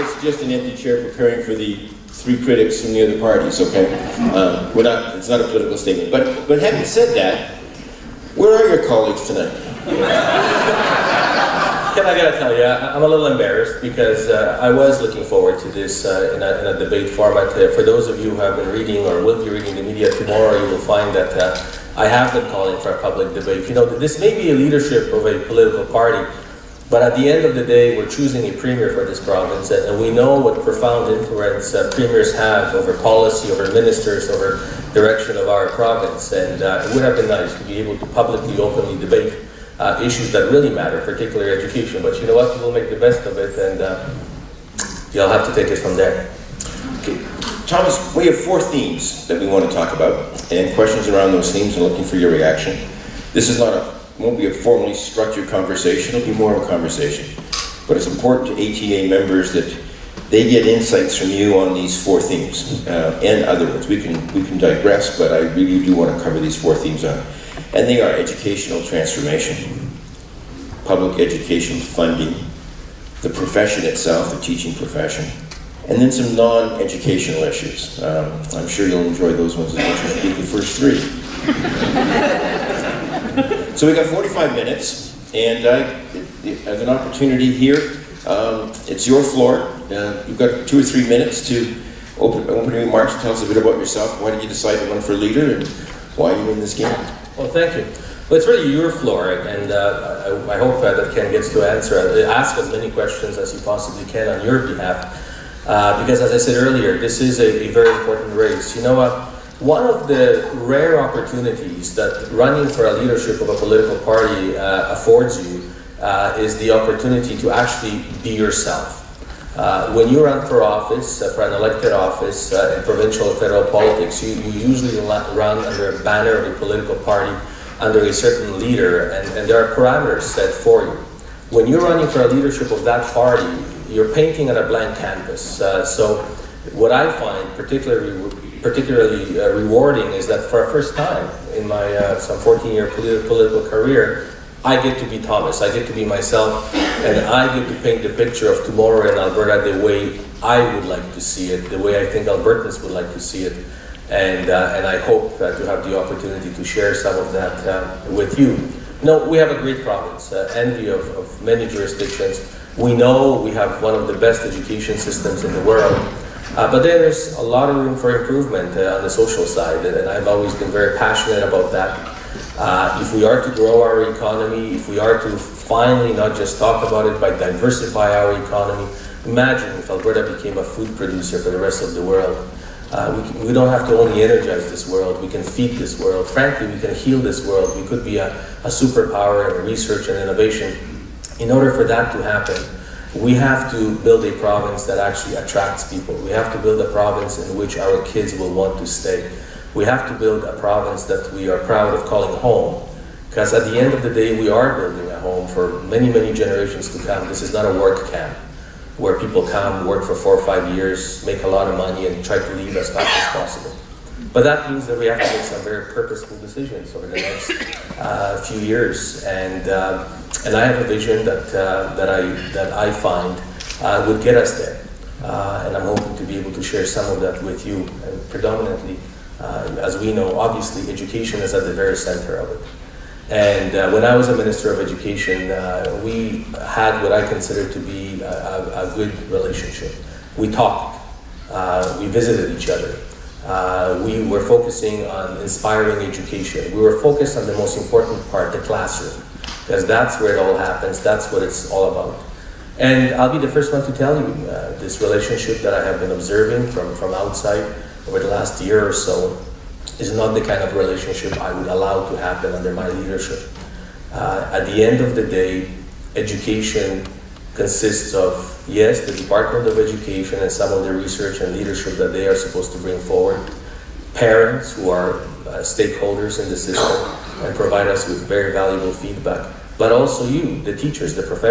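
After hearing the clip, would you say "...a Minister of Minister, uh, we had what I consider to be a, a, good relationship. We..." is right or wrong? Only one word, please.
wrong.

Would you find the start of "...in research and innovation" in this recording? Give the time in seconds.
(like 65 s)
189 s.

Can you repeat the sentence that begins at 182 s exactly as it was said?
Uh, we, can, we, don't have to only energize this world, we can feed this world.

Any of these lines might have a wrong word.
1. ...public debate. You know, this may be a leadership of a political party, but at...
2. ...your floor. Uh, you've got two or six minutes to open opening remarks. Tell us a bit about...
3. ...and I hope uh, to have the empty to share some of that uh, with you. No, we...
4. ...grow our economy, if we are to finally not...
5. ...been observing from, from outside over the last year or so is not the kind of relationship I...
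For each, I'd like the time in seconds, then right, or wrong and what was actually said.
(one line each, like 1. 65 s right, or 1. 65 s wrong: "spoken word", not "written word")
1. 23 s right
2. 89 s wrong: "three", not "six"
3. 154 s wrong: "opportunity", not "empty"
4. 173 s right
5. 255 s right.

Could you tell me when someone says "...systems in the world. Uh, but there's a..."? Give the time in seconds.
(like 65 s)
164 s.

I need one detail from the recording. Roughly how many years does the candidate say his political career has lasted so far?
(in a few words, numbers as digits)
14.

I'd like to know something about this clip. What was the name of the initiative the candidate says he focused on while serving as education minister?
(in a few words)
Inspiring Education.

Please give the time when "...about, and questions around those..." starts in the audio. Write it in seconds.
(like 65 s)
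49 s.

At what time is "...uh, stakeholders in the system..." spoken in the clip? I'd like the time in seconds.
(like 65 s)
275 s.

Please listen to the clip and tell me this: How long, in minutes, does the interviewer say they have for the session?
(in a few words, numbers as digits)
45.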